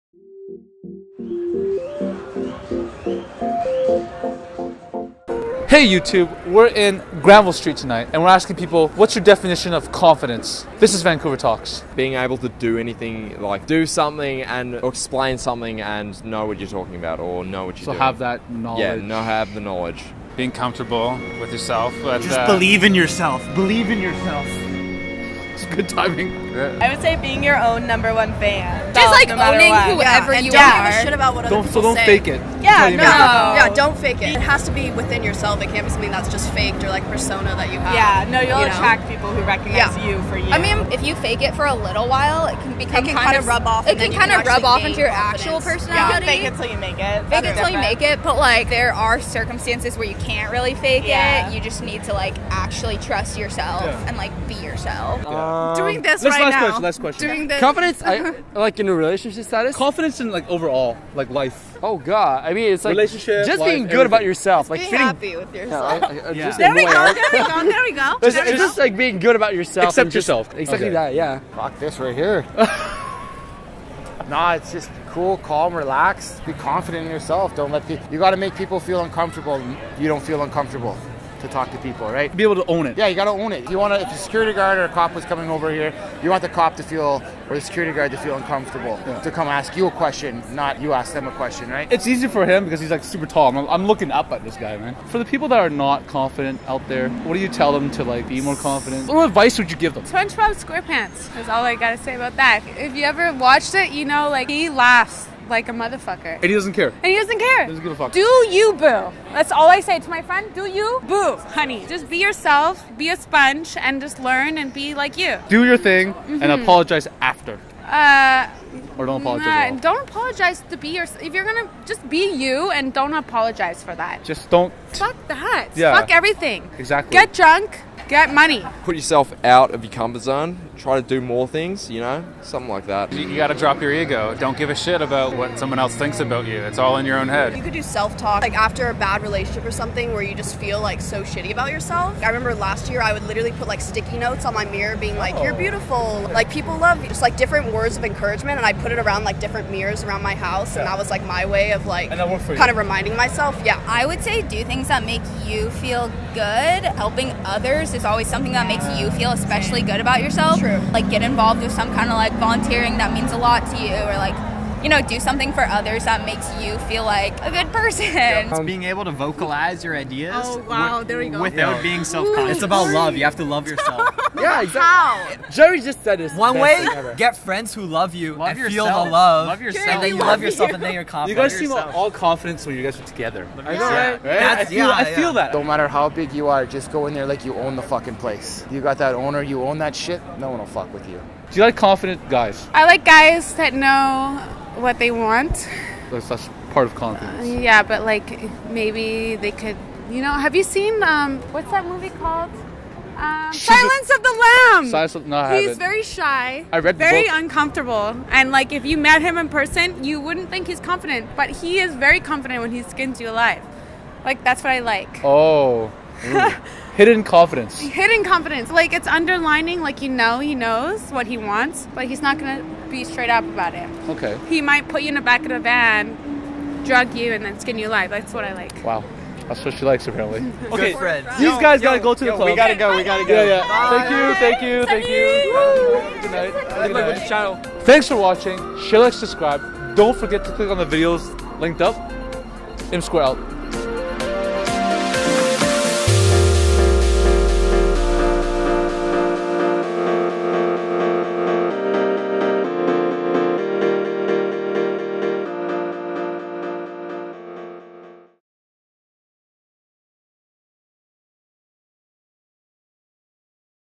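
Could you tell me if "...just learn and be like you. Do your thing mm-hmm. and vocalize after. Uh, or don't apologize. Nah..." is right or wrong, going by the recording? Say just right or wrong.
wrong.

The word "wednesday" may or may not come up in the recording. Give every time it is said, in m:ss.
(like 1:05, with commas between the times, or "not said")
not said.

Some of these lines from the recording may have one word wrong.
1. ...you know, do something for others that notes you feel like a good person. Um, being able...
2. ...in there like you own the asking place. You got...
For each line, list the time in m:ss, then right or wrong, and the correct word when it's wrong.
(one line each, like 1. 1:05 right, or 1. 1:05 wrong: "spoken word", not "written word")
1. 2:44 wrong: "makes", not "notes"
2. 3:07 wrong: "fucking", not "asking".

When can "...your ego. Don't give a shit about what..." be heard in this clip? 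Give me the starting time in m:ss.
2:13.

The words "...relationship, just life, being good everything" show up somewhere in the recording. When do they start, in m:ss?
1:02.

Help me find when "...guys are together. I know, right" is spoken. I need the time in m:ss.
3:02.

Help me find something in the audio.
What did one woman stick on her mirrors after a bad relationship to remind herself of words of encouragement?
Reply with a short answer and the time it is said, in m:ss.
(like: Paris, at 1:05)
Sticky notes, at 2:23.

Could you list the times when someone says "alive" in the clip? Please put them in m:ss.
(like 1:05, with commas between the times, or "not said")
3:33, 3:47.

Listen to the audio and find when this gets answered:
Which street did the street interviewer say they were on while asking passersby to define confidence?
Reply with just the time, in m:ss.
0:07.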